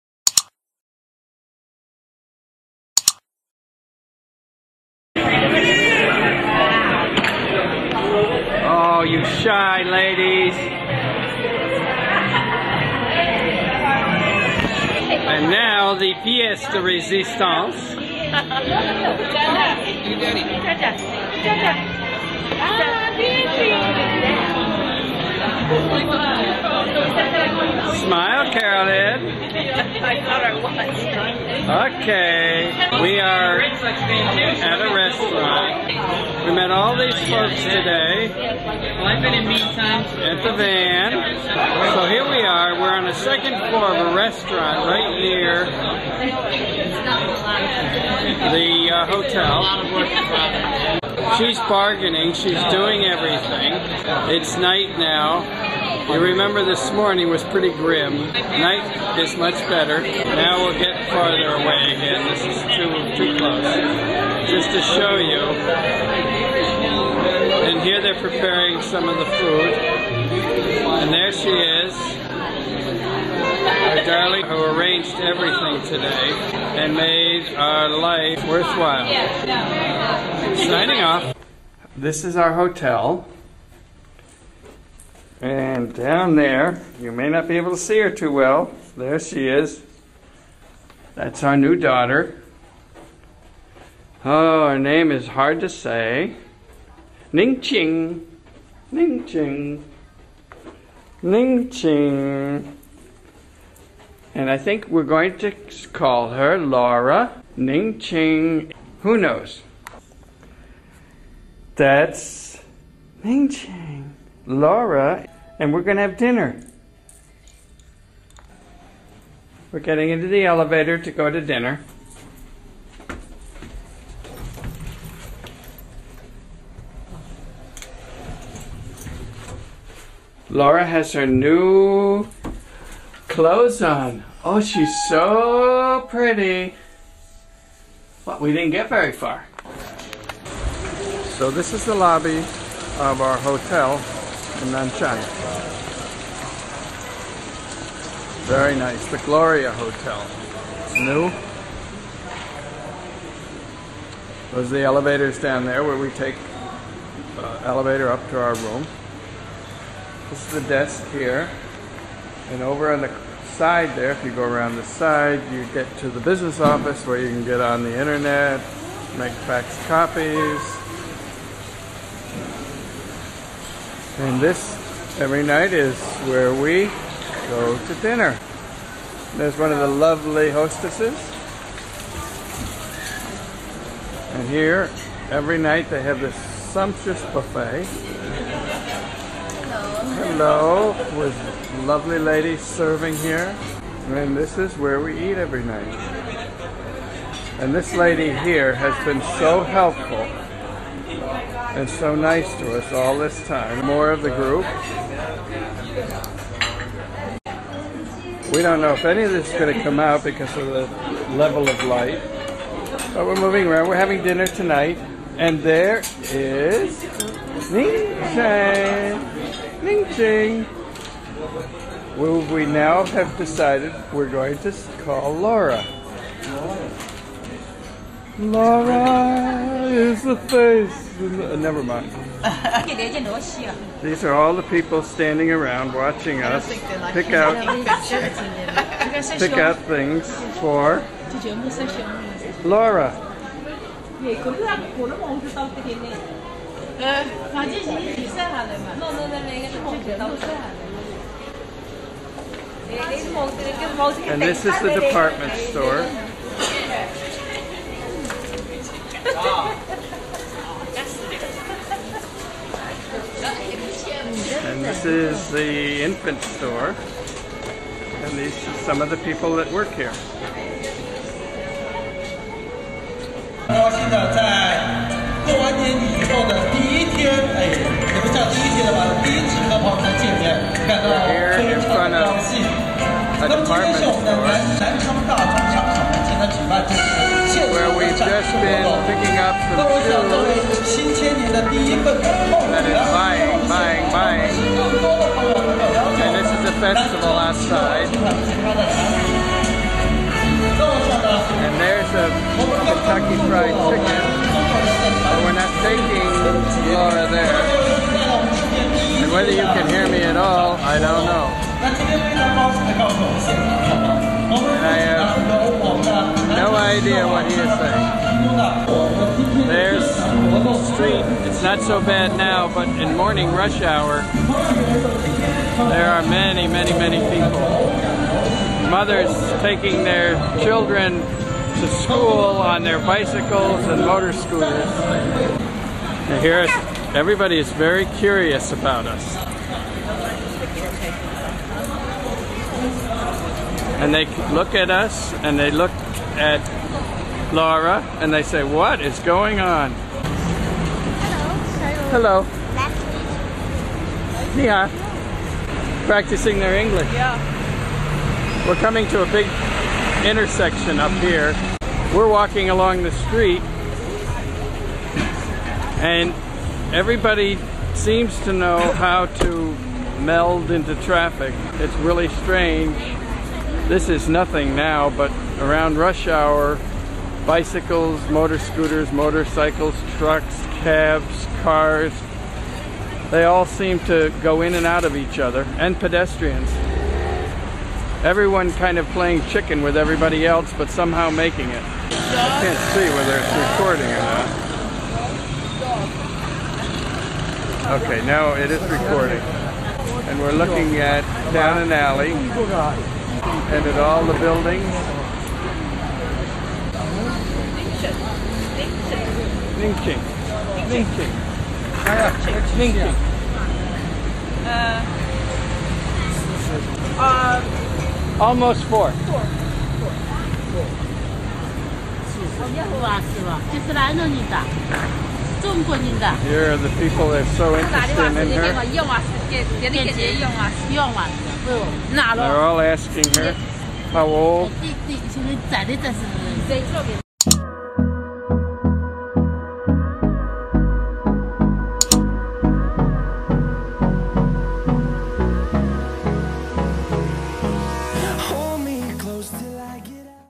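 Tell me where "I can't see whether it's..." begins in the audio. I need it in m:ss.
6:32.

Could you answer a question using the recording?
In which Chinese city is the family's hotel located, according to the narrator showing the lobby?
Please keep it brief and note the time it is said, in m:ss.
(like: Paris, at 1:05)
Nanchang, at 2:24.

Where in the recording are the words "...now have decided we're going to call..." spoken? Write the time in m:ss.
3:42.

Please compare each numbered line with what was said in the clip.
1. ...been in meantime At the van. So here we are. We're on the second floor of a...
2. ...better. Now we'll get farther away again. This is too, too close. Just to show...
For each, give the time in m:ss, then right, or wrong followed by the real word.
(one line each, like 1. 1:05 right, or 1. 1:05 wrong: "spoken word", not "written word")
1. 0:39 right
2. 0:59 right.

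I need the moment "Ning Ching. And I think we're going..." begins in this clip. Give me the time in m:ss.
1:41.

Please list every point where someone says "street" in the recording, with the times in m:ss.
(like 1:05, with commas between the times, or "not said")
5:20, 6:03.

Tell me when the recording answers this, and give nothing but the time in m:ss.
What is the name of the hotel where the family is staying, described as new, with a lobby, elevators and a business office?
2:29.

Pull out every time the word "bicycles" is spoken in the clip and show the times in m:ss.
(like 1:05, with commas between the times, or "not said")
5:32, 6:17.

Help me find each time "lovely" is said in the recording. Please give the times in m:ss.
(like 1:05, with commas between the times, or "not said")
2:59, 3:11.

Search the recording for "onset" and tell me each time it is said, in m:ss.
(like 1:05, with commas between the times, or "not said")
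not said.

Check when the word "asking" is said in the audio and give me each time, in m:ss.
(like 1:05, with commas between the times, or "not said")
7:12.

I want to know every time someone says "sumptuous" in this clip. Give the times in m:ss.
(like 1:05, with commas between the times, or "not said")
3:06.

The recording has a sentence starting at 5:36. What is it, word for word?
And here, everybody is very curious about us.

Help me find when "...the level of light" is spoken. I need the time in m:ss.
3:30.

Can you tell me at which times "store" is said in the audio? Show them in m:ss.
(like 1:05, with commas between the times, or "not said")
4:15, 4:26.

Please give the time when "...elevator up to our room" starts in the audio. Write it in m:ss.
2:37.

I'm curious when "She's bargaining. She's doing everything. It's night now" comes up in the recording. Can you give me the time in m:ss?
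0:51.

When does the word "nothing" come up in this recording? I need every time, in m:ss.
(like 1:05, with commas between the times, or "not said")
6:14.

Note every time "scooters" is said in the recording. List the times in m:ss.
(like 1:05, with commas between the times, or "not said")
5:34, 6:18.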